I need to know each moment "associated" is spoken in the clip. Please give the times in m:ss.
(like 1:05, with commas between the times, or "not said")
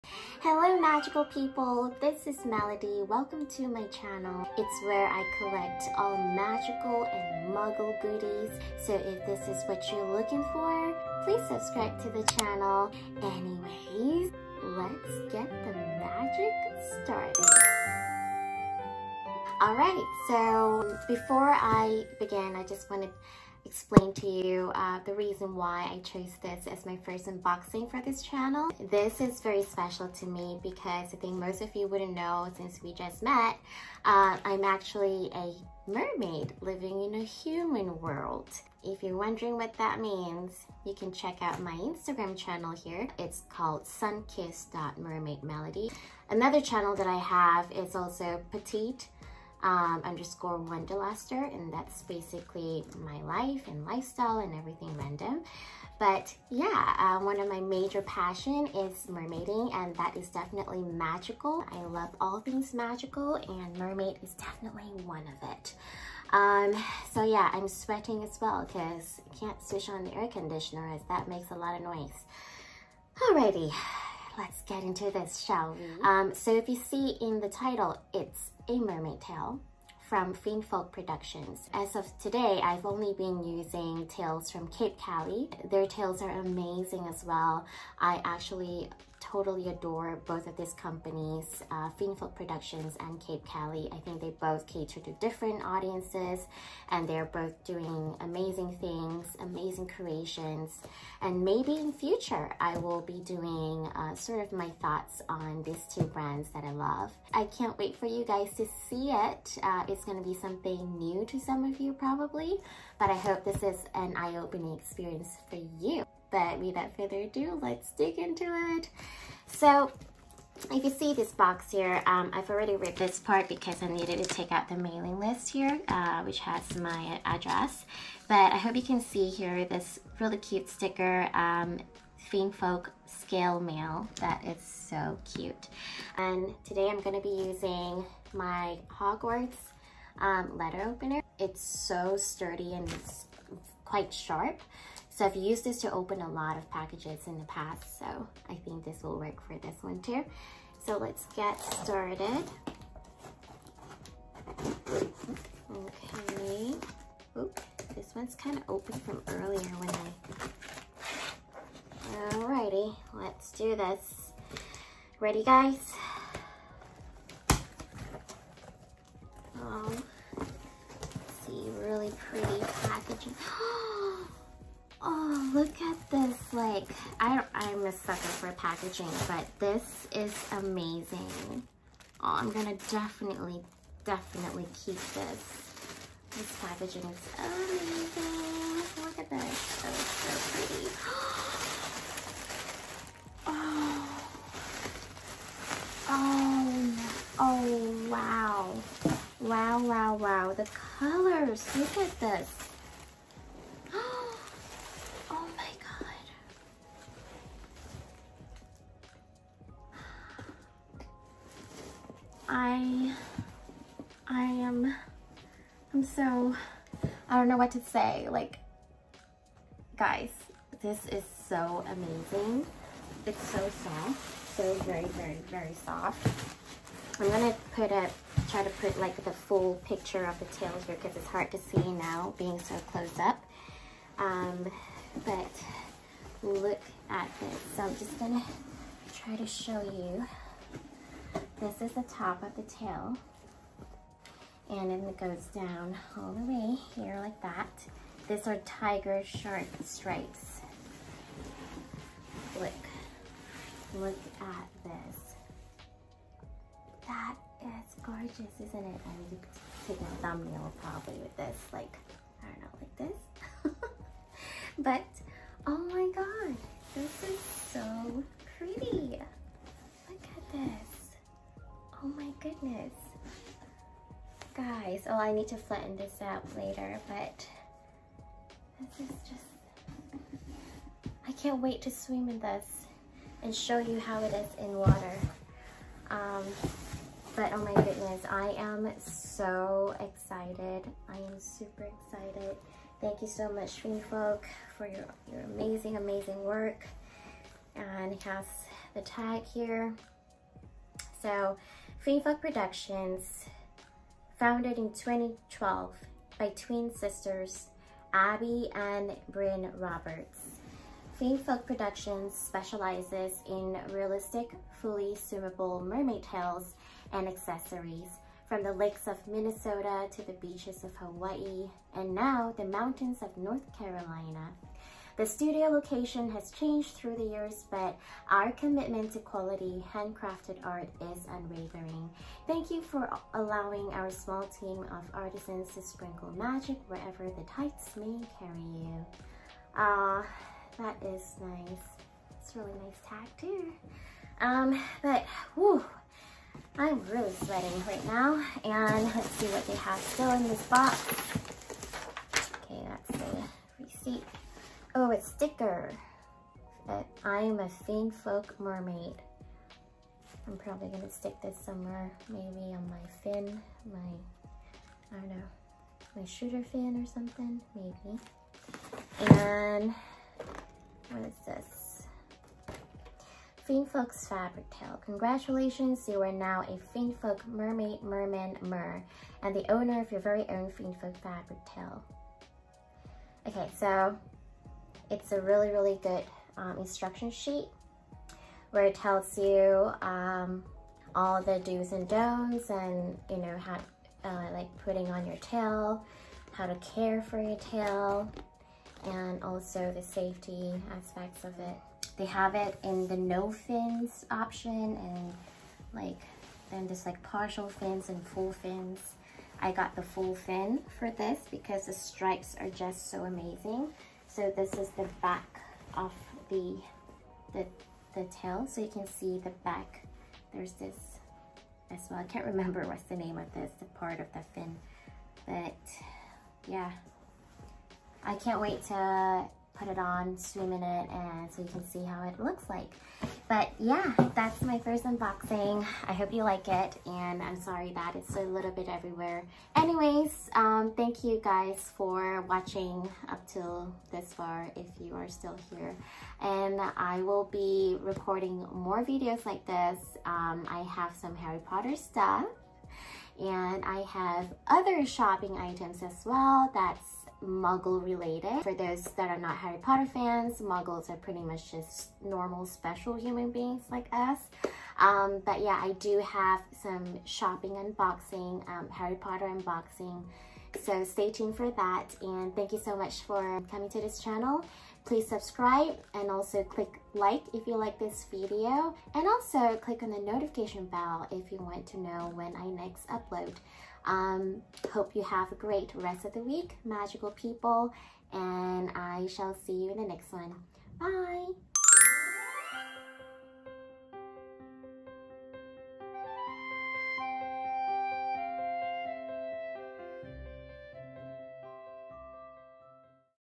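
not said.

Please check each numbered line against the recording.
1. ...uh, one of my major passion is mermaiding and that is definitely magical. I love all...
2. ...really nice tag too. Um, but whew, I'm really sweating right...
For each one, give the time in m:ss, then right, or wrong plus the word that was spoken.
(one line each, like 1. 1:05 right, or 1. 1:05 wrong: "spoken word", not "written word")
1. 0:56 right
2. 5:42 right.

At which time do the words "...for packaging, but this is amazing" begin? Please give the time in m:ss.
2:58.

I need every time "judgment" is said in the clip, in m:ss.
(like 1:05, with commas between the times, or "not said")
not said.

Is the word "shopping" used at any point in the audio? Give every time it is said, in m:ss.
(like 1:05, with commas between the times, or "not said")
7:35, 7:47.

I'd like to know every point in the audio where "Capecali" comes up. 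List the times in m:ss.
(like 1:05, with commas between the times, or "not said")
1:24, 1:33.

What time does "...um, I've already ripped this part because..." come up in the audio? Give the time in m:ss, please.
2:02.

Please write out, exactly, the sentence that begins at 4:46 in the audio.
Um, but oh my goodness, I am so excited.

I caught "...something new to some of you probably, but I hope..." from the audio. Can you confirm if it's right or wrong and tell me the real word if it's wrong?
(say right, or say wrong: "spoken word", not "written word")
right.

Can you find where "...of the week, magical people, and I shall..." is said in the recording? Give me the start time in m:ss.
8:06.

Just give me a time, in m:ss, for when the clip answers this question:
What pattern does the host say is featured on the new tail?
4:08.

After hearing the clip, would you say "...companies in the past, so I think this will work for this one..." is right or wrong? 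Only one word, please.
wrong.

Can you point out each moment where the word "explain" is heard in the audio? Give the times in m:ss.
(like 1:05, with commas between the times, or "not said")
0:23.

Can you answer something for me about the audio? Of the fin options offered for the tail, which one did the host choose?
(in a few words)
Full fin.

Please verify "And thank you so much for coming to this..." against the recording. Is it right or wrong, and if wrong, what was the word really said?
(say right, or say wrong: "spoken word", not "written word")
right.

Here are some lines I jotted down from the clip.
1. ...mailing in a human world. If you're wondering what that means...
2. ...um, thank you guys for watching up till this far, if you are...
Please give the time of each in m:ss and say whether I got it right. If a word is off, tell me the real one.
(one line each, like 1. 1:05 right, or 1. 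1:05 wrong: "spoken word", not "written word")
1. 0:36 wrong: "living", not "mailing"
2. 7:20 right.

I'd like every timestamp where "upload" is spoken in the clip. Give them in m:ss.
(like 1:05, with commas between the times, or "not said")
8:03.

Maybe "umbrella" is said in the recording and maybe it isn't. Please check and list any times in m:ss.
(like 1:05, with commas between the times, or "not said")
not said.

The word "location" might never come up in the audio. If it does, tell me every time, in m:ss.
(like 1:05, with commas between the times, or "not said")
5:25.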